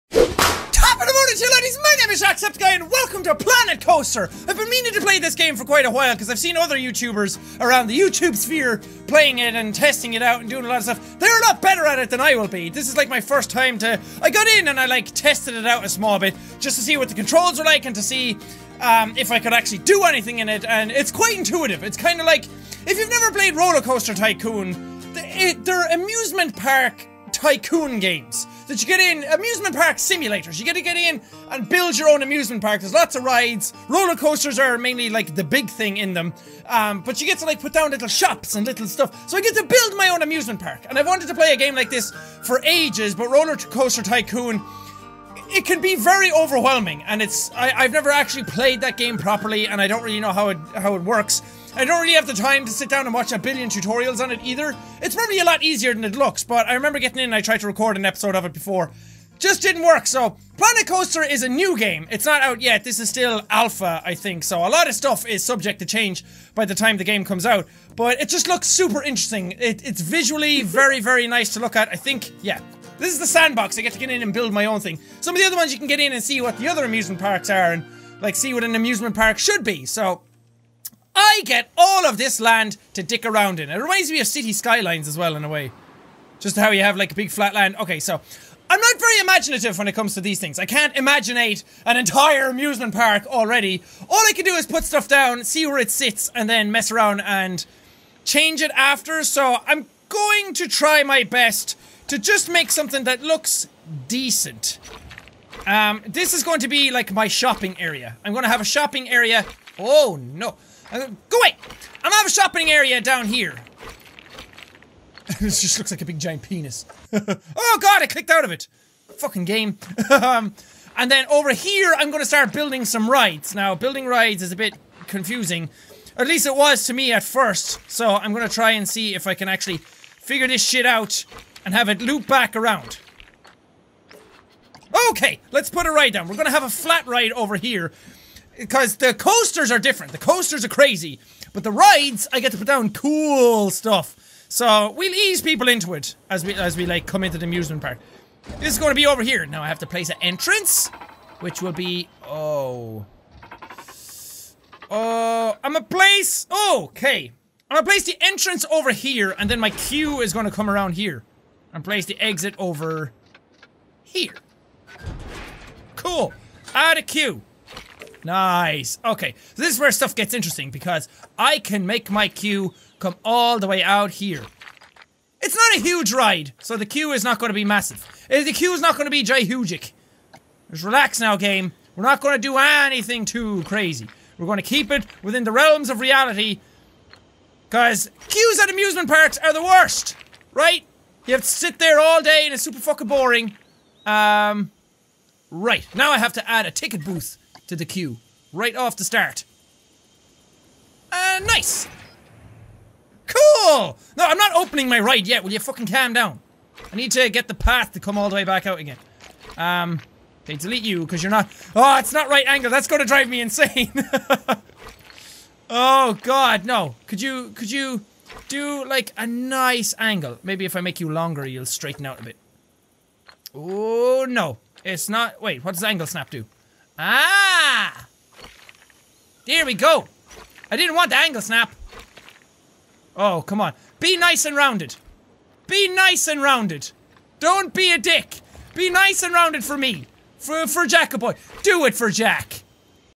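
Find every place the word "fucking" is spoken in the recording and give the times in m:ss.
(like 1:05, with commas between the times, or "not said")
1:59, 3:12, 3:25.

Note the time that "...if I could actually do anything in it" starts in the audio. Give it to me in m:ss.
0:19.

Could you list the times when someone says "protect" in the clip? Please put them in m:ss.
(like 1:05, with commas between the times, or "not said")
not said.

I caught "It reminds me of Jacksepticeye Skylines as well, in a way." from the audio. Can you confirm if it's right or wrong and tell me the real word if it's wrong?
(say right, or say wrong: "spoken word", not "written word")
wrong: "Cities", not "Jacksepticeye".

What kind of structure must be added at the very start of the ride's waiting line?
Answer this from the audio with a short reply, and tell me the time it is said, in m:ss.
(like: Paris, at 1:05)
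Ticket booth, at 3:16.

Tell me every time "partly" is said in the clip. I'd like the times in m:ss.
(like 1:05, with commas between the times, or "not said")
not said.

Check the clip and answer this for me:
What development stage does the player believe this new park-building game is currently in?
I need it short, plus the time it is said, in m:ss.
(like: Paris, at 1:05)
Alpha, at 1:03.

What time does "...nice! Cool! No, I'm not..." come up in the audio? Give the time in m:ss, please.
3:21.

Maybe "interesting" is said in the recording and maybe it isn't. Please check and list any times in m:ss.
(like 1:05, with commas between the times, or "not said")
1:09, 2:50.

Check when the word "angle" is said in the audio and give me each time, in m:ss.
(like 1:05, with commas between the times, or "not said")
3:32, 3:39, 3:45, 3:51.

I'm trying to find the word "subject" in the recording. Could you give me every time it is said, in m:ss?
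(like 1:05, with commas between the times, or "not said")
1:05.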